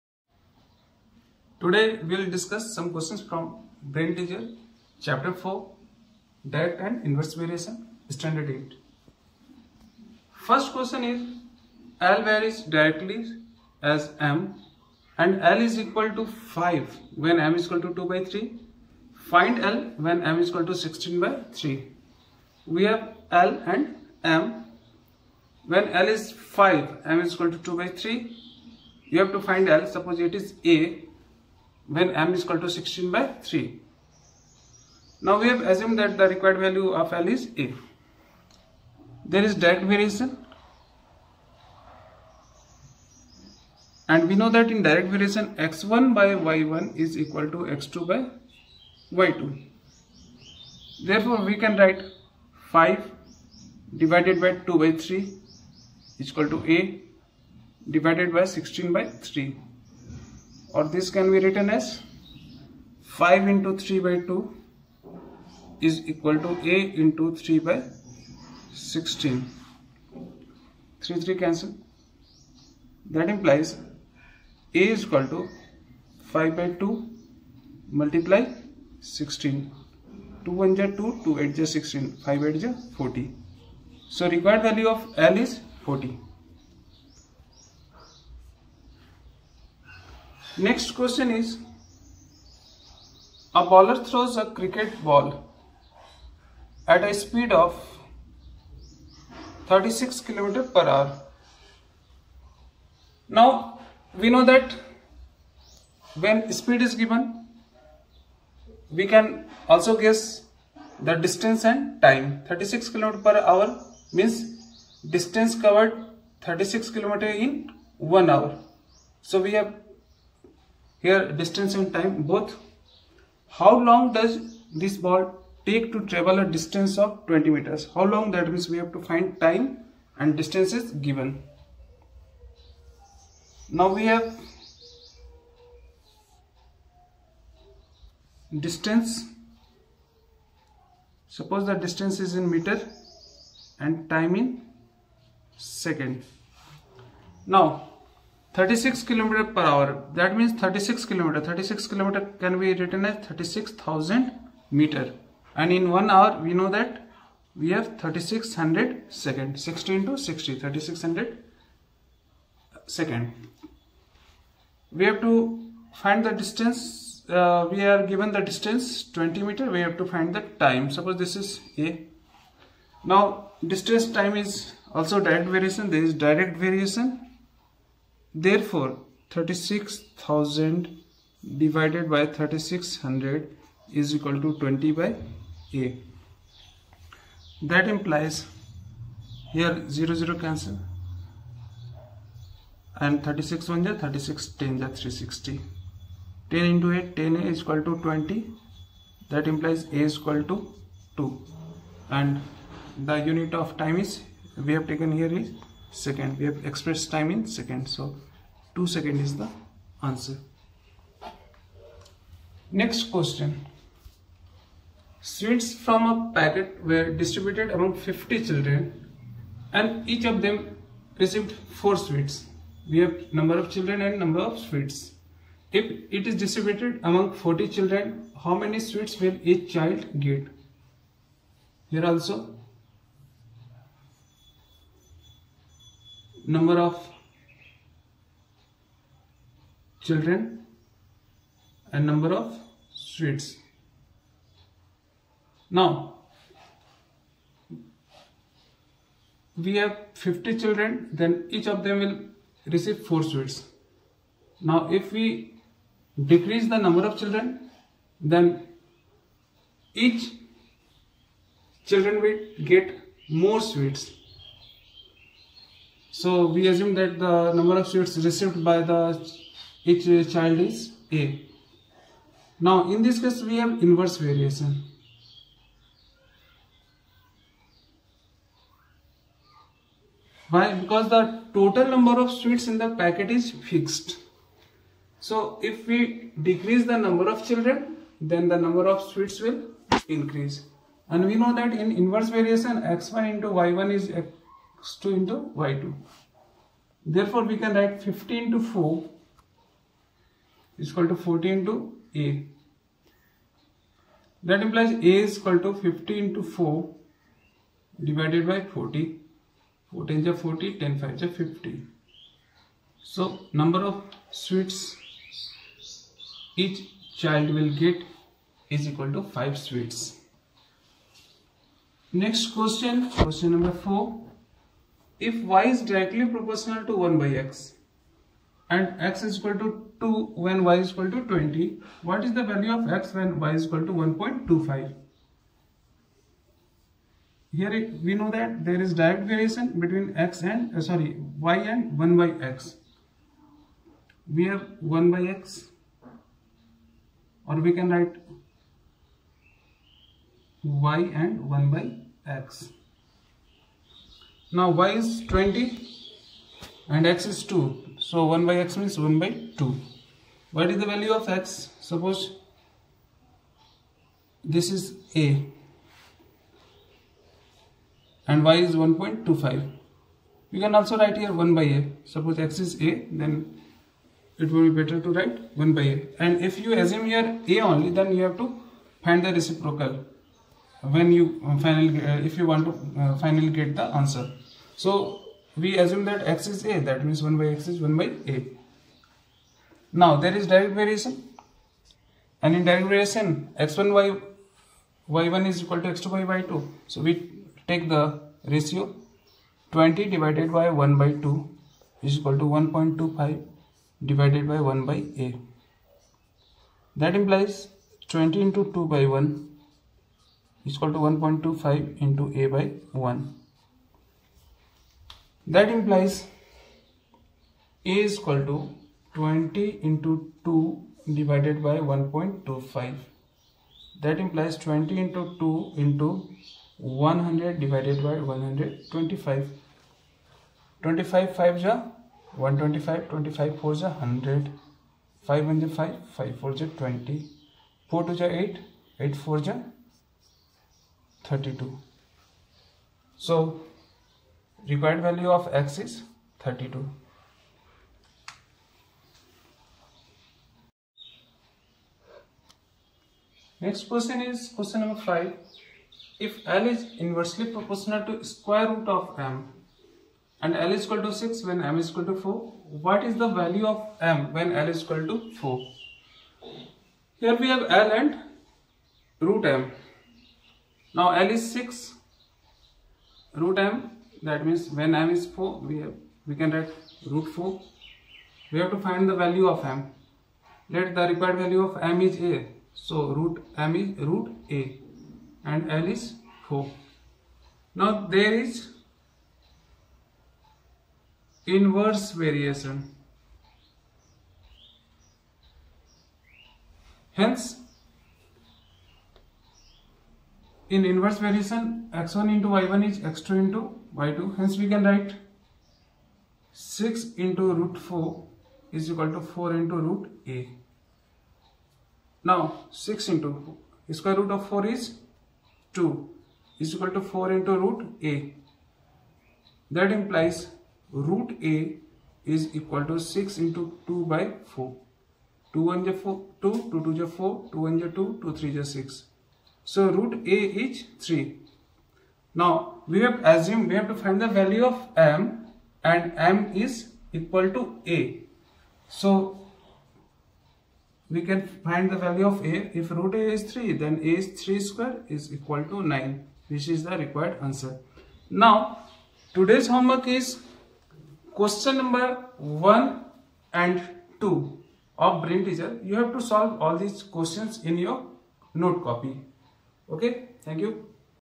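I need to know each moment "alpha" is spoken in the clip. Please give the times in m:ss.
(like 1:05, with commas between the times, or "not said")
not said.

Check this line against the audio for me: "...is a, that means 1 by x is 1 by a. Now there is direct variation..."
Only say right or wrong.
right.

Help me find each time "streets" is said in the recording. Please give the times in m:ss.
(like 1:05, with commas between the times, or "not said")
4:02.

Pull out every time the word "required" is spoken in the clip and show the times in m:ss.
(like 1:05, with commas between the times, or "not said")
0:36, 1:24, 7:24, 8:01, 9:06.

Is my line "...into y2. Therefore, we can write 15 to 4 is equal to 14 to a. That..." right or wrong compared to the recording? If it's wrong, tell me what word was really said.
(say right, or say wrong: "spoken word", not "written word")
right.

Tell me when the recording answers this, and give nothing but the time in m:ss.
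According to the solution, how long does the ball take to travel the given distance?
3:28.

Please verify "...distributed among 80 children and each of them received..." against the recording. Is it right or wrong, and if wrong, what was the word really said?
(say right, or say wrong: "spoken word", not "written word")
wrong: "50", not "80".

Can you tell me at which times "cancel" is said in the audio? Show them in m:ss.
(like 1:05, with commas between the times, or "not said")
1:11, 3:10.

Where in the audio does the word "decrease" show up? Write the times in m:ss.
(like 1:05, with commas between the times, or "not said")
4:16, 4:46.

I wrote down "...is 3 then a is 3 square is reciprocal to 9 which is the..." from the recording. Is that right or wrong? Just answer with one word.
wrong.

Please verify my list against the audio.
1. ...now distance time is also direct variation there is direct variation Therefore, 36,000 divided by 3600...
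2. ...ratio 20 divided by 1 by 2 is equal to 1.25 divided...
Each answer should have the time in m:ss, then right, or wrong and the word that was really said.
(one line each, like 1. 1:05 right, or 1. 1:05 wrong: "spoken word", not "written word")
1. 2:53 right
2. 6:38 right.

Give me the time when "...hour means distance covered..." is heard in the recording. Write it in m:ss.
1:53.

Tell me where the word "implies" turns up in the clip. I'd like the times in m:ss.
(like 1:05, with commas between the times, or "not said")
1:13, 3:07, 3:19, 5:04, 6:47, 8:39.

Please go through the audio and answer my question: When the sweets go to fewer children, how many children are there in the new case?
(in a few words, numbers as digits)
40.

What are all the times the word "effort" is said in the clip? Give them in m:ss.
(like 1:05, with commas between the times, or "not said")
not said.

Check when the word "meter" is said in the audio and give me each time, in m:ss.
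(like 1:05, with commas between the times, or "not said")
2:07, 2:22, 2:34, 2:49.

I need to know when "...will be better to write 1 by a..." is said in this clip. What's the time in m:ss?
6:14.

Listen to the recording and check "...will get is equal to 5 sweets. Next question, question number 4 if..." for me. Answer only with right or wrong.
right.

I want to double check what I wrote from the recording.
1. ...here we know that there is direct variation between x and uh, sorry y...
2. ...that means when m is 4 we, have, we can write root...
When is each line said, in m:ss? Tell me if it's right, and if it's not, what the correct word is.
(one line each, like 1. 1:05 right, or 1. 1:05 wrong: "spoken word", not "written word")
1. 5:37 right
2. 7:54 right.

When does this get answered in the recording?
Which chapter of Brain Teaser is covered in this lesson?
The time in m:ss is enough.
0:04.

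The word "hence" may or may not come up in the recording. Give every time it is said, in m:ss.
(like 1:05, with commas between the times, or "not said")
8:17, 8:24.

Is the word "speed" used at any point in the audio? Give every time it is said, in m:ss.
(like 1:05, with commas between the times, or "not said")
1:37, 1:46.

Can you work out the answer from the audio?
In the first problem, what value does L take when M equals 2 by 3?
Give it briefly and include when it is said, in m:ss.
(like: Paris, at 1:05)
5, at 0:15.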